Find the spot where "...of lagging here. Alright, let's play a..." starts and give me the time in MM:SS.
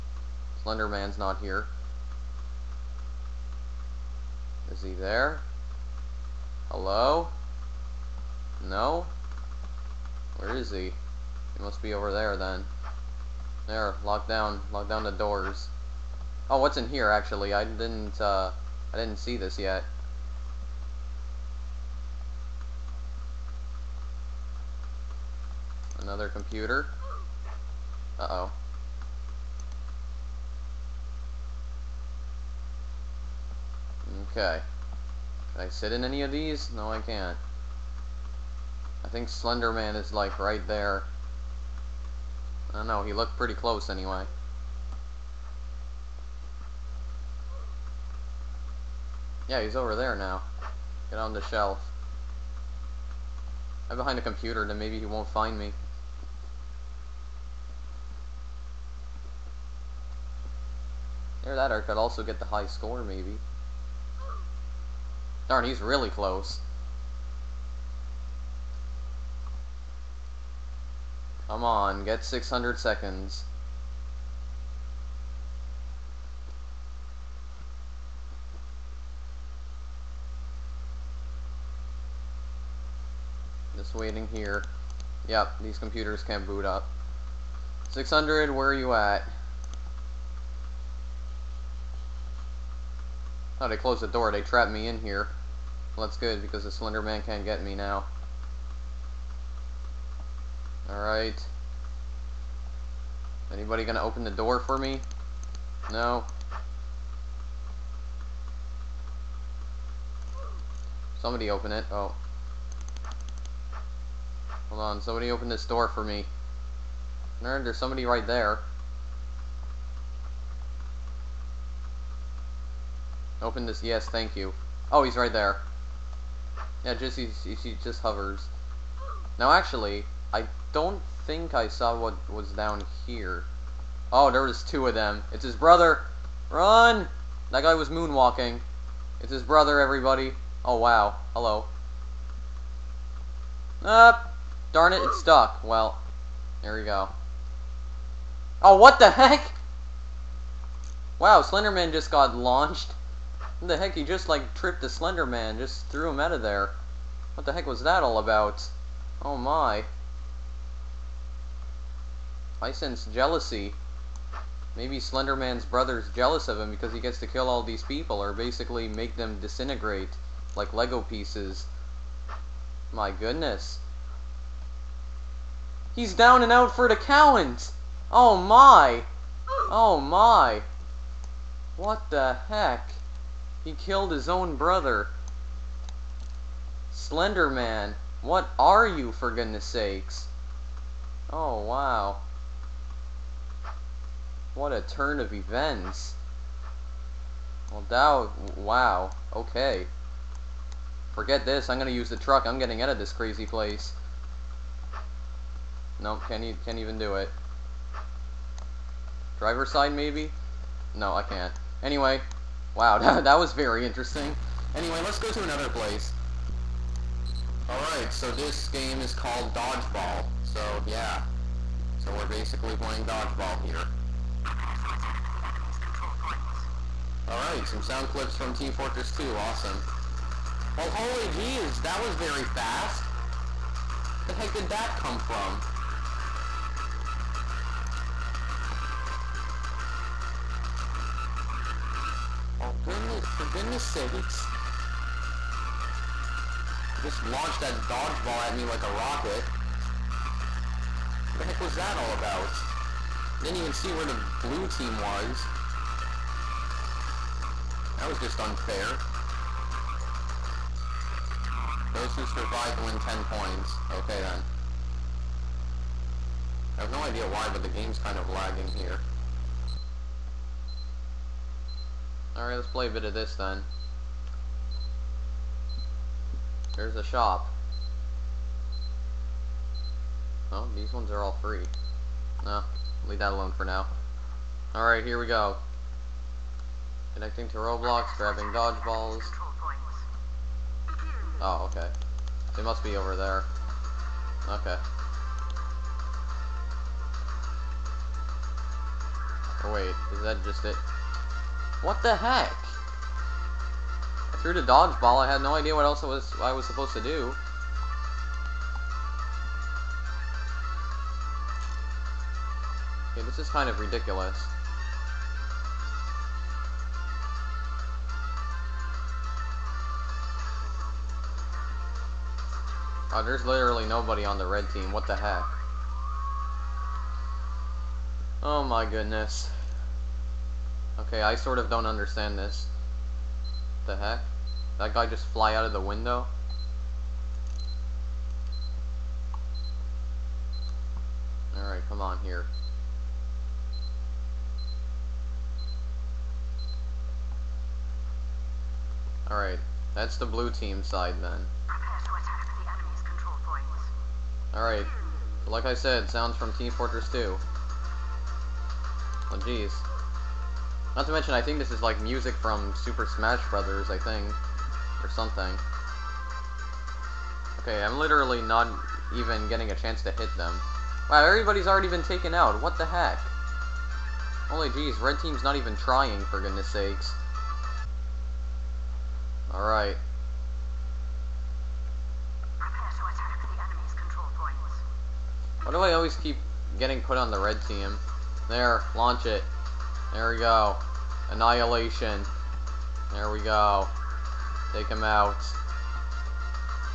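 04:28.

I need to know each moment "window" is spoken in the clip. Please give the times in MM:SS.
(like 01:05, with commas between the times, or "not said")
05:35.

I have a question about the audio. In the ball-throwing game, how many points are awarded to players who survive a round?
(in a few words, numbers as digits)
10.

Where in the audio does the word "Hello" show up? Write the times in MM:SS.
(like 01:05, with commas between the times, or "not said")
00:06, 02:21.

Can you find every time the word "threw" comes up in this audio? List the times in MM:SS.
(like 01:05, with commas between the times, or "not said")
02:35, 05:04.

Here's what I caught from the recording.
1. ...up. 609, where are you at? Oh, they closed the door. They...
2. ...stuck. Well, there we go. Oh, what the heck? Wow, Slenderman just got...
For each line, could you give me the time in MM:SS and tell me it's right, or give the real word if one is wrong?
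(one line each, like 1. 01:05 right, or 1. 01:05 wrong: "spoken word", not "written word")
1. 01:26 wrong: "600", not "609"
2. 02:25 right.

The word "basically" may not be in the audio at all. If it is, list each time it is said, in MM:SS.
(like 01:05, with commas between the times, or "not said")
02:48, 03:42.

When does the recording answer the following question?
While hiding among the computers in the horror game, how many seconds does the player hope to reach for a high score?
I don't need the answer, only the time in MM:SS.
01:12.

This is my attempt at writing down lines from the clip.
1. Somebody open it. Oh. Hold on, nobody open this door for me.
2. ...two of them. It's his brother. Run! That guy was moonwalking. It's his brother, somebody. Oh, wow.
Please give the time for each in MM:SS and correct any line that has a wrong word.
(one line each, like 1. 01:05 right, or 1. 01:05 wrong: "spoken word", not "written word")
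1. 01:51 wrong: "somebody", not "nobody"
2. 02:14 wrong: "everybody", not "somebody".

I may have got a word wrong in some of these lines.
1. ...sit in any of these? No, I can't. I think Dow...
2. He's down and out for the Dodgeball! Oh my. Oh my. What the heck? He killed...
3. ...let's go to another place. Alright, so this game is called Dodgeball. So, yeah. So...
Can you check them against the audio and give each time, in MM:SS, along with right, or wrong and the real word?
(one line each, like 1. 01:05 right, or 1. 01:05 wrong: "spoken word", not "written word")
1. 00:35 wrong: "Slenderman", not "Dow"
2. 02:55 wrong: "Cowans", not "Dodgeball"
3. 03:35 right.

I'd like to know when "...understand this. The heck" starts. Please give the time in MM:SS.
05:31.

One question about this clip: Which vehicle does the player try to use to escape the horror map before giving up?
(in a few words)
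The truck.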